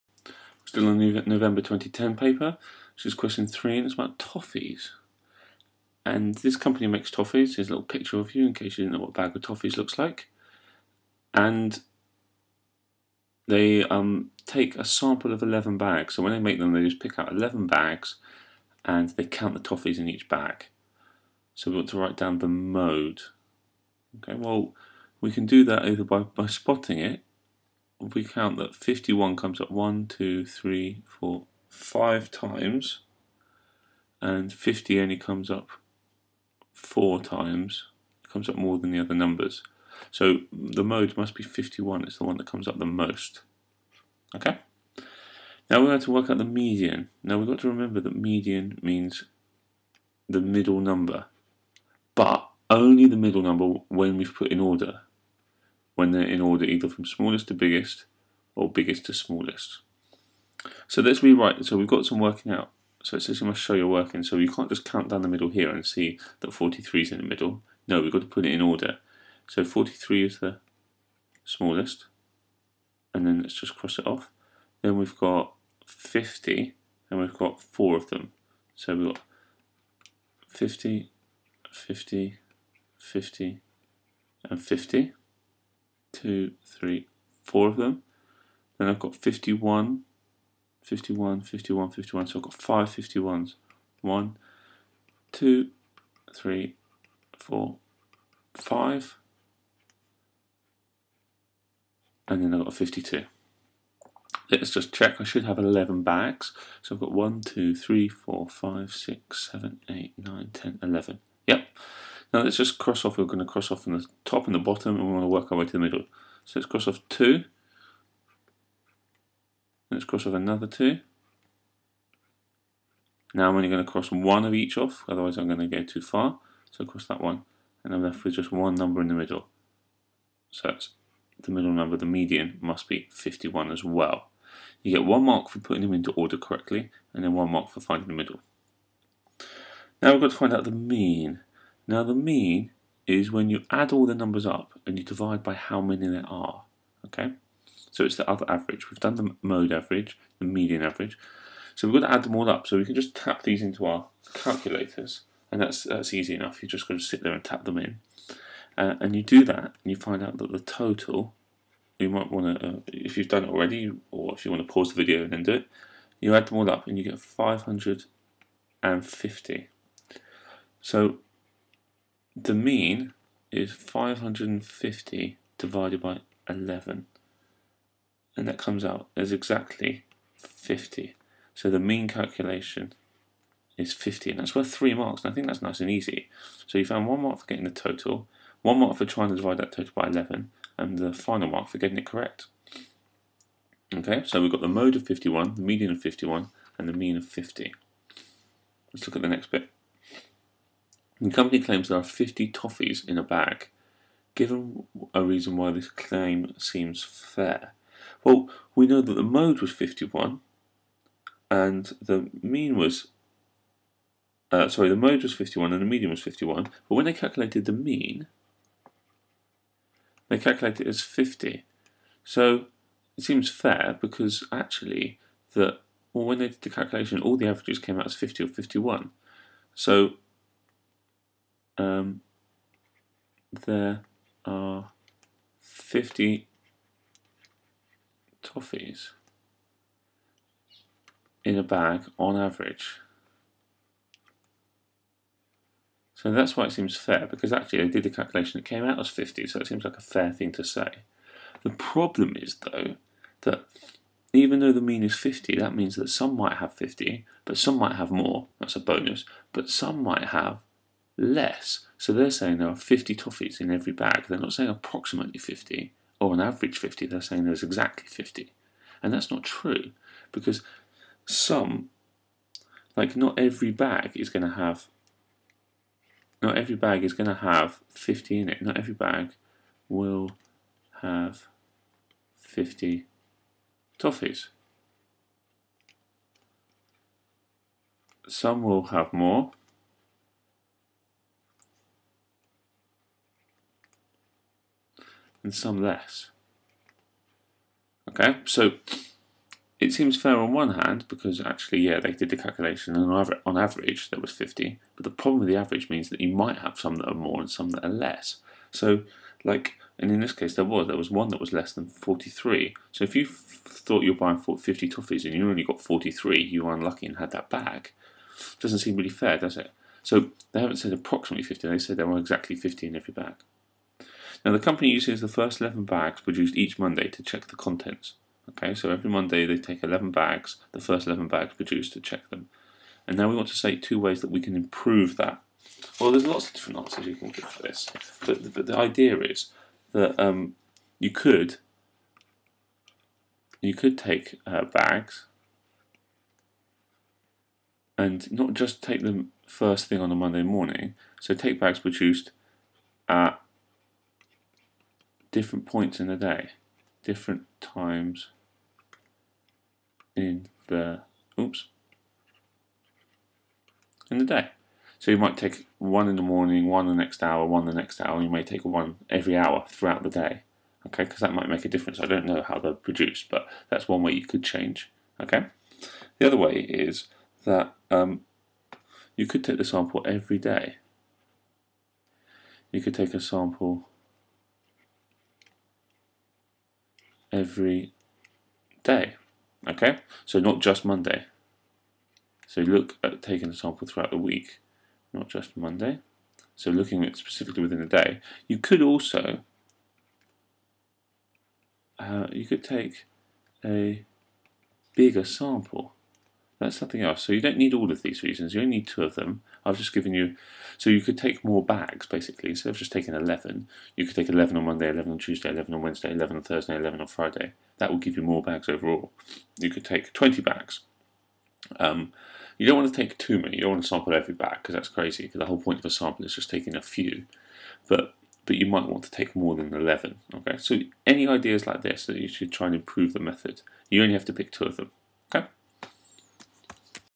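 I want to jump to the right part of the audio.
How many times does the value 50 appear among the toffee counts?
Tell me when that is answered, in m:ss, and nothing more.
0:34.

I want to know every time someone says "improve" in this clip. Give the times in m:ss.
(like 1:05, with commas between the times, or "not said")
5:34, 7:12.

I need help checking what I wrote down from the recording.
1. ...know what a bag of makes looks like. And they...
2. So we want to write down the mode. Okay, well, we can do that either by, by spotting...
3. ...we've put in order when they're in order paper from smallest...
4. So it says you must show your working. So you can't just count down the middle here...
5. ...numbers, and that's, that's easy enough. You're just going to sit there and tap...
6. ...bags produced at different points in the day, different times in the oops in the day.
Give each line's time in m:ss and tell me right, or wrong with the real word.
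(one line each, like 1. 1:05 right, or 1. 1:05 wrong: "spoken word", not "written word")
1. 0:08 wrong: "toffees", not "makes"
2. 0:21 right
3. 0:54 wrong: "either", not "paper"
4. 1:03 right
5. 2:34 wrong: "calculators", not "numbers"
6. 5:51 right.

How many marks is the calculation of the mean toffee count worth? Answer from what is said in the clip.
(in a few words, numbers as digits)
3.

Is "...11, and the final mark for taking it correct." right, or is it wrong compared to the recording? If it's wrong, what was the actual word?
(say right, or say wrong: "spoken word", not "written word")
wrong: "getting", not "taking".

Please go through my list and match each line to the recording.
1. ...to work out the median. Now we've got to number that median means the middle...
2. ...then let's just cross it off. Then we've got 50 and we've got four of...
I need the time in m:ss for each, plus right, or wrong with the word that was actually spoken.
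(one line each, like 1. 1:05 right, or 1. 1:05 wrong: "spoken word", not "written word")
1. 0:46 wrong: "remember", not "number"
2. 1:13 right.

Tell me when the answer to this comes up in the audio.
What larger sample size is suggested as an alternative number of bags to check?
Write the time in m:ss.
7:00.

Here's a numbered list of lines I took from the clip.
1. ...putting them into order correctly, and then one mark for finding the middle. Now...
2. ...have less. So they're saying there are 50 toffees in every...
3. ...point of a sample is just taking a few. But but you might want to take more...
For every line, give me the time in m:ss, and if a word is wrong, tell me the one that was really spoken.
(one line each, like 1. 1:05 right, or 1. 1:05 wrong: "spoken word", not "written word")
1. 2:15 right
2. 4:20 right
3. 7:05 right.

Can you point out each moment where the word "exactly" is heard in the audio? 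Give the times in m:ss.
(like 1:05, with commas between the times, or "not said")
2:59, 4:27, 5:22.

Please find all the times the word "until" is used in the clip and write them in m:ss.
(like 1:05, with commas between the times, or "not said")
not said.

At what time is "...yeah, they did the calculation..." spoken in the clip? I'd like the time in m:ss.
5:01.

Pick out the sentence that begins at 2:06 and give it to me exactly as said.
So cross that one, and I'm left with just one number in the middle.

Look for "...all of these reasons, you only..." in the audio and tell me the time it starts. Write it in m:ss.
6:47.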